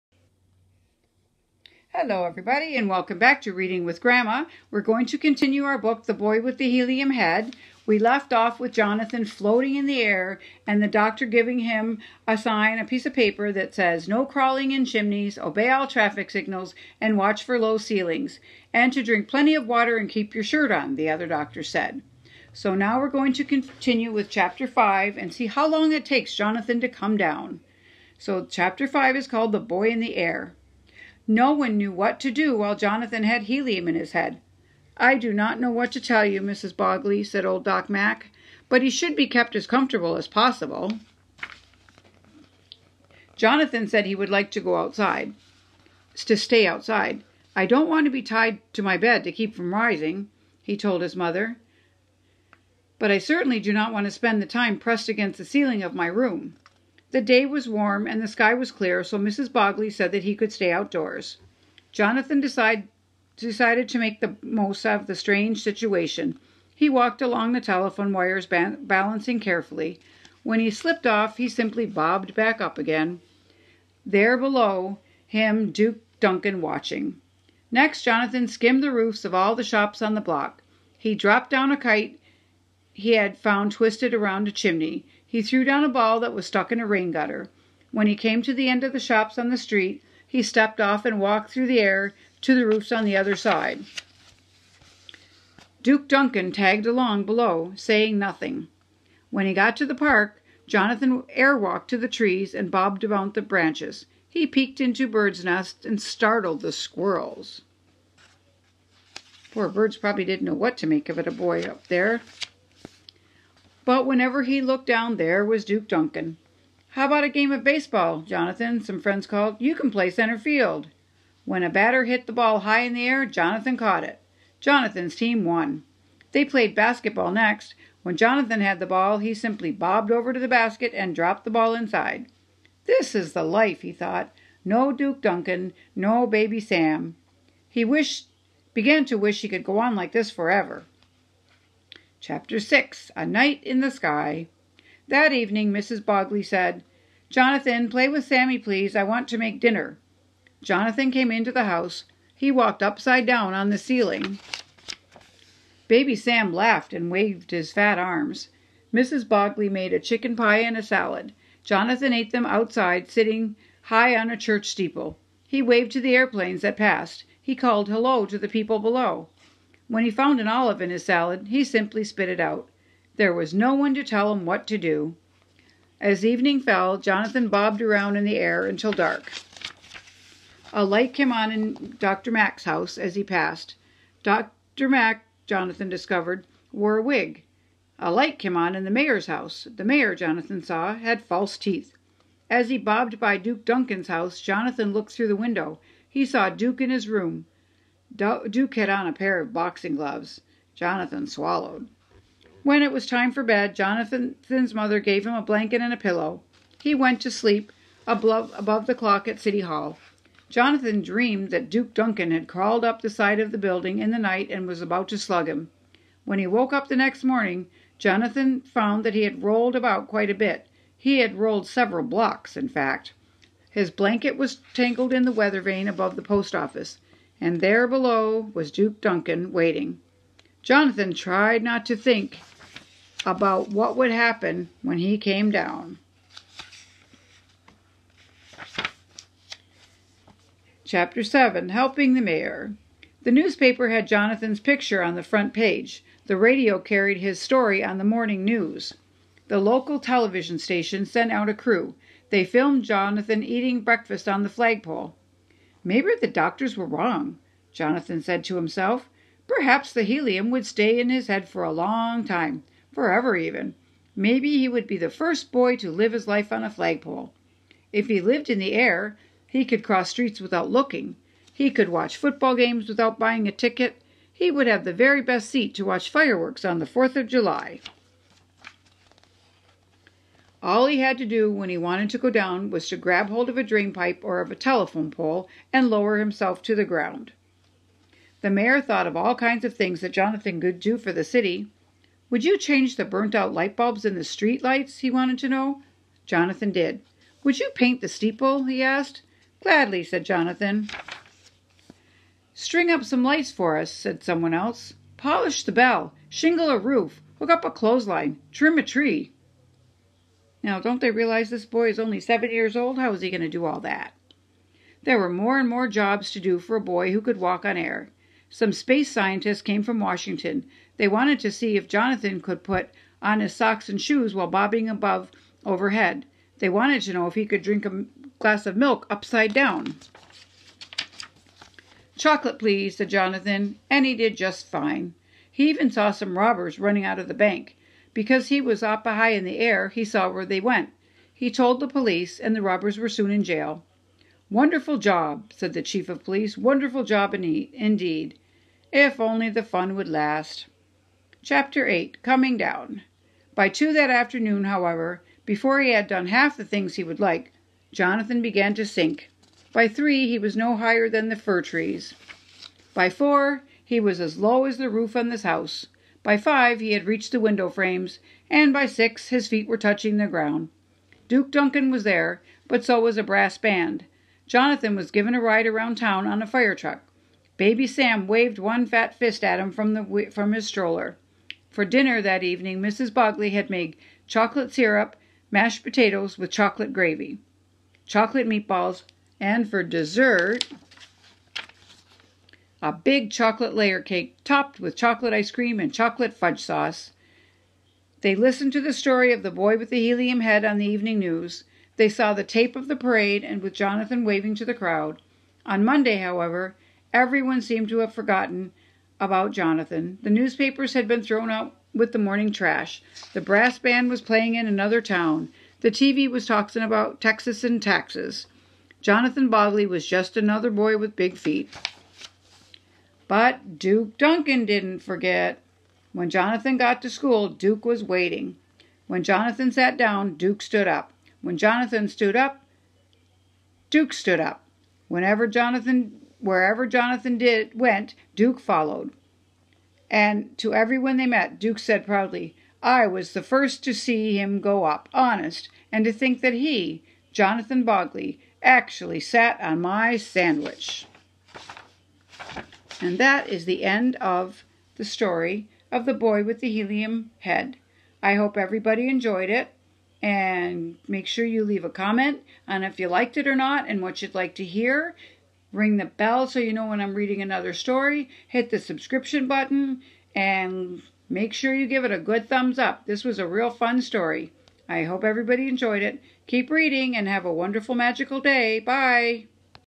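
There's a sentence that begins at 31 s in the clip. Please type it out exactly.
No one knew what to do while Jonathan had helium in his head.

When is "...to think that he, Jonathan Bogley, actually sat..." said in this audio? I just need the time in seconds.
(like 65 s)
446 s.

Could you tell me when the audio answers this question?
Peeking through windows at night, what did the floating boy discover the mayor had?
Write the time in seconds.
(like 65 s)
191 s.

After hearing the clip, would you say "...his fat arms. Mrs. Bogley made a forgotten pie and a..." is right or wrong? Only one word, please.
wrong.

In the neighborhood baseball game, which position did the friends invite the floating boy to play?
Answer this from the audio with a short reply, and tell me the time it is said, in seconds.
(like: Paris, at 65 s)
Center field, at 120 s.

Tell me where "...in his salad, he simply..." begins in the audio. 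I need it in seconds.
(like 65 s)
170 s.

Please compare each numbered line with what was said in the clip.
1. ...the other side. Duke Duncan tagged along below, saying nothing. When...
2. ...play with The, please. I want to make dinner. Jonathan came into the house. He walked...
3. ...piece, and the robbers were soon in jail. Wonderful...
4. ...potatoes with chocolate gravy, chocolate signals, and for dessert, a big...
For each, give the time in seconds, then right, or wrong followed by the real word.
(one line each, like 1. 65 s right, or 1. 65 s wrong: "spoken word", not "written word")
1. 93 s right
2. 147 s wrong: "Sammy", not "The"
3. 341 s wrong: "police", not "piece"
4. 385 s wrong: "meatballs", not "signals".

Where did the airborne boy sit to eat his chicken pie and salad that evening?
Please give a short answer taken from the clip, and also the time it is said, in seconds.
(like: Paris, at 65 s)
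A church steeple, at 164 s.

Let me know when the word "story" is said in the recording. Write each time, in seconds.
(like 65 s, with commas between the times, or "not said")
247 s, 398 s, 455 s, 467 s, 474 s.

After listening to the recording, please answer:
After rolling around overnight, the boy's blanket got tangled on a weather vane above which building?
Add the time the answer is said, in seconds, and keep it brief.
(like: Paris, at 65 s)
The post office, at 226 s.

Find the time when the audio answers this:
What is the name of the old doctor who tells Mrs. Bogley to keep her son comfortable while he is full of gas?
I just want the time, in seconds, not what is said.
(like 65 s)
37 s.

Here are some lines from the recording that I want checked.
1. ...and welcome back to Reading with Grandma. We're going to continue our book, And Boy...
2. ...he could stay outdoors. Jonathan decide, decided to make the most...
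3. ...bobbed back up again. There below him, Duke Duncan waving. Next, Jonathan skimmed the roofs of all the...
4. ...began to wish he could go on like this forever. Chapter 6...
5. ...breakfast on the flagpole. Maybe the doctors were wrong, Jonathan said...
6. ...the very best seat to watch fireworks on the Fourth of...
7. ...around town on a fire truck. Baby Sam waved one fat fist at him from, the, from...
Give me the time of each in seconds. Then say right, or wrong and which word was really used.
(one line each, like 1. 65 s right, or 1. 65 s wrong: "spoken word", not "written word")
1. 2 s wrong: "The", not "And"
2. 60 s right
3. 71 s wrong: "watching", not "waving"
4. 138 s right
5. 253 s right
6. 274 s right
7. 375 s right.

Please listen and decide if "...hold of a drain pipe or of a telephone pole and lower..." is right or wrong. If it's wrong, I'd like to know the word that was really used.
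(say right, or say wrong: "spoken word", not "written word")
right.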